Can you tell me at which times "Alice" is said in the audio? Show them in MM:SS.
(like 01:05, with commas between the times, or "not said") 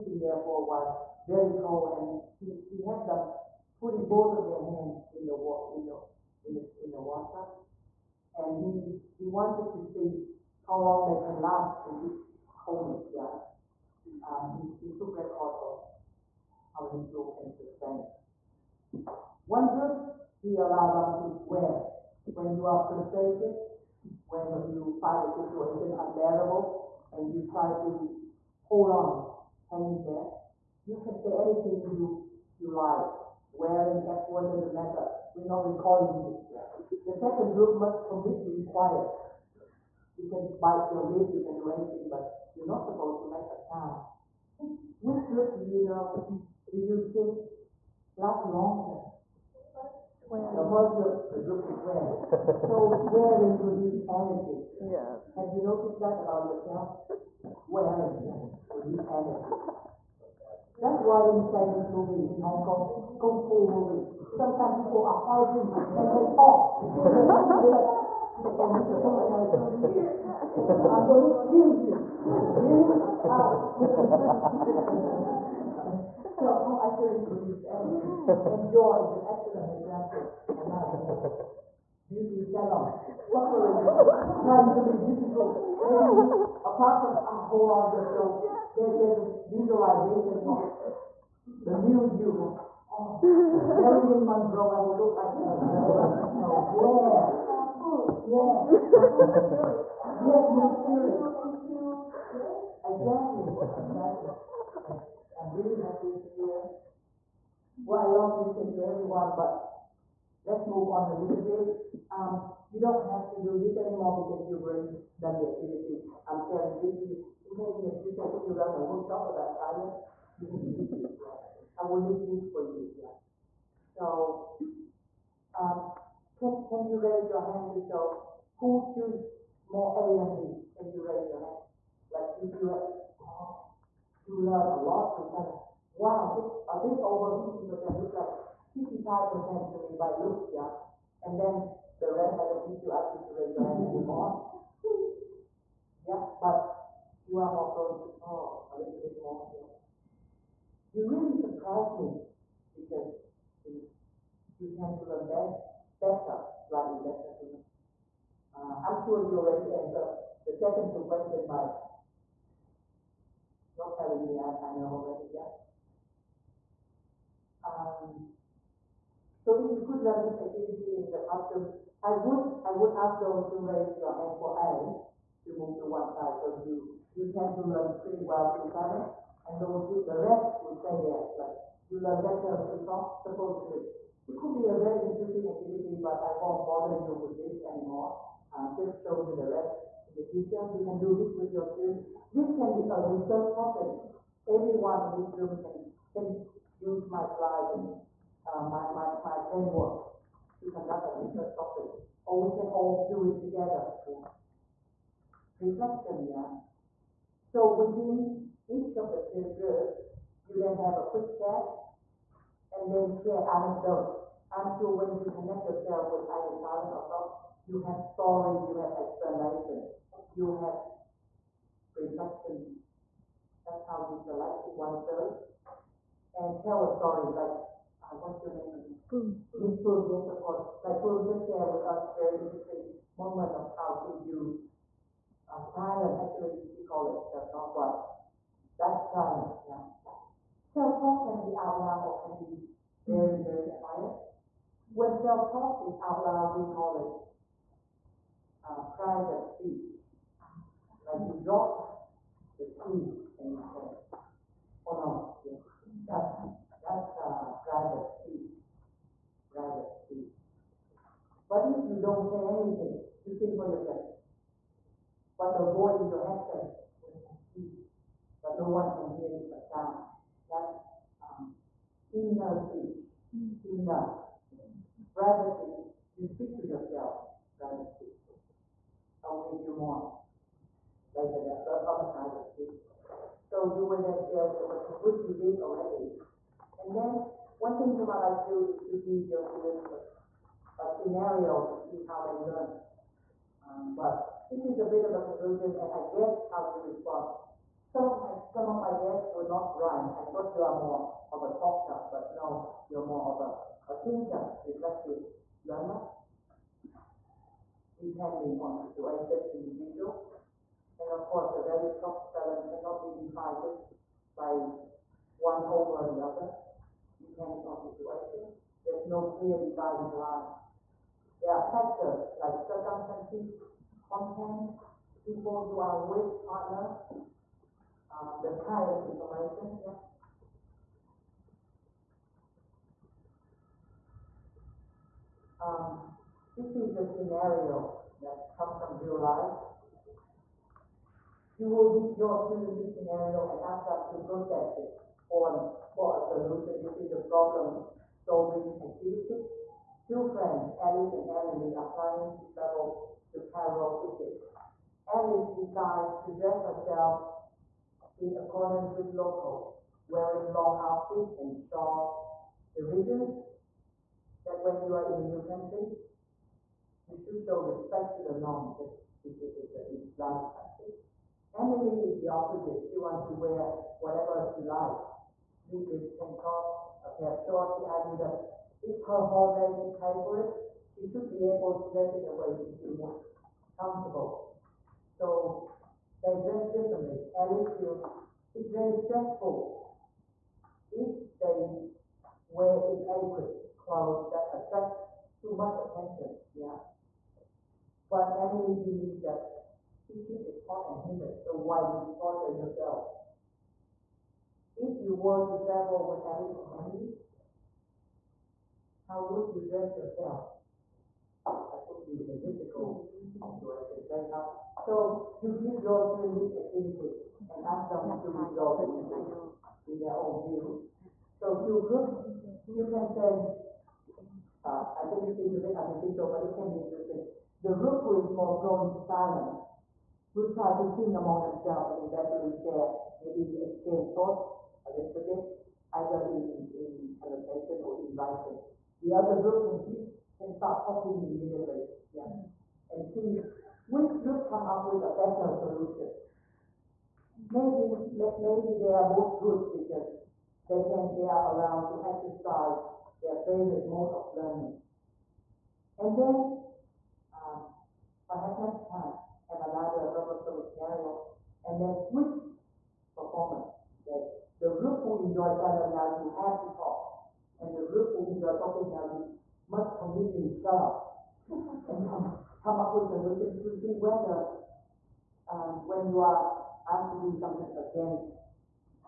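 05:50, 05:55, 06:27, 06:46.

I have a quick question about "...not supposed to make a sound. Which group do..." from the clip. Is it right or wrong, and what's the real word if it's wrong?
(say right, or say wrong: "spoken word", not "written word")
right.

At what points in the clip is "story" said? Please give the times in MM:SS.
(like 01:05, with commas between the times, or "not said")
03:38, 03:46.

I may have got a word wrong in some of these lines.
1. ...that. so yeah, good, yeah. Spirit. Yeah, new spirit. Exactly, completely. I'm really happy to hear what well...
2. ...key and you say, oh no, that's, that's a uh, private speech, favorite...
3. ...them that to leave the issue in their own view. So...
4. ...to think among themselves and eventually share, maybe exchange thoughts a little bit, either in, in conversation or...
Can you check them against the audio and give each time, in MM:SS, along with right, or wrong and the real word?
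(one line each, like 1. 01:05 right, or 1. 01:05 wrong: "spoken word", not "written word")
1. 01:35 wrong: "exactly", not "completely"
2. 04:12 wrong: "private", not "favorite"
3. 06:57 wrong: "resolve", not "leave"
4. 07:10 right.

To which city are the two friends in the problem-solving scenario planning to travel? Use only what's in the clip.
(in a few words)
Cairo.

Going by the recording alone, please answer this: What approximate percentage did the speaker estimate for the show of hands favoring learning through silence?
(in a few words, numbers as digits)
55%.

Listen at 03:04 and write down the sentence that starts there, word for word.
It could be a very interesting activity, but I won't bother you with this anymore.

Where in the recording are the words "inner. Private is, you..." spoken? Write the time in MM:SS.
04:33.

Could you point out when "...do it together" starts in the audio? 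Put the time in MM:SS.
03:23.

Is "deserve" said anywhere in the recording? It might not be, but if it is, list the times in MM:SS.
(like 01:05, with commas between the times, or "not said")
not said.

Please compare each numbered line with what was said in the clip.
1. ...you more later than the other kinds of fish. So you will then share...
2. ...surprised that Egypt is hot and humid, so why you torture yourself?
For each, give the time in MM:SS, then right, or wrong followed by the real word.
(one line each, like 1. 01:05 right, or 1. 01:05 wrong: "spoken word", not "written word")
1. 04:39 right
2. 06:38 wrong: "believed", not "surprised".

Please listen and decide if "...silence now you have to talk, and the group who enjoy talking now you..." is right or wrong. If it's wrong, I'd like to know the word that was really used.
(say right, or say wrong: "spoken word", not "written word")
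right.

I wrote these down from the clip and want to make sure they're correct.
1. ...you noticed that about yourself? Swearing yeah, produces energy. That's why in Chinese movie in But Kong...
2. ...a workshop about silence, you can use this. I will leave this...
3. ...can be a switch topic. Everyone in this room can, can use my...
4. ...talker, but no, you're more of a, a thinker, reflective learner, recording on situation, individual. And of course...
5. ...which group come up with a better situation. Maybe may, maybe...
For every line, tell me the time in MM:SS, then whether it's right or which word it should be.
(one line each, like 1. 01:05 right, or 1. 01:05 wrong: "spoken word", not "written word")
1. 00:55 wrong: "Hong", not "But"
2. 01:58 right
3. 03:12 wrong: "research", not "switch"
4. 05:01 wrong: "depending", not "recording"
5. 07:23 wrong: "solution", not "situation".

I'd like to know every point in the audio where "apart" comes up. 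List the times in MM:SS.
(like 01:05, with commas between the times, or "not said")
01:26.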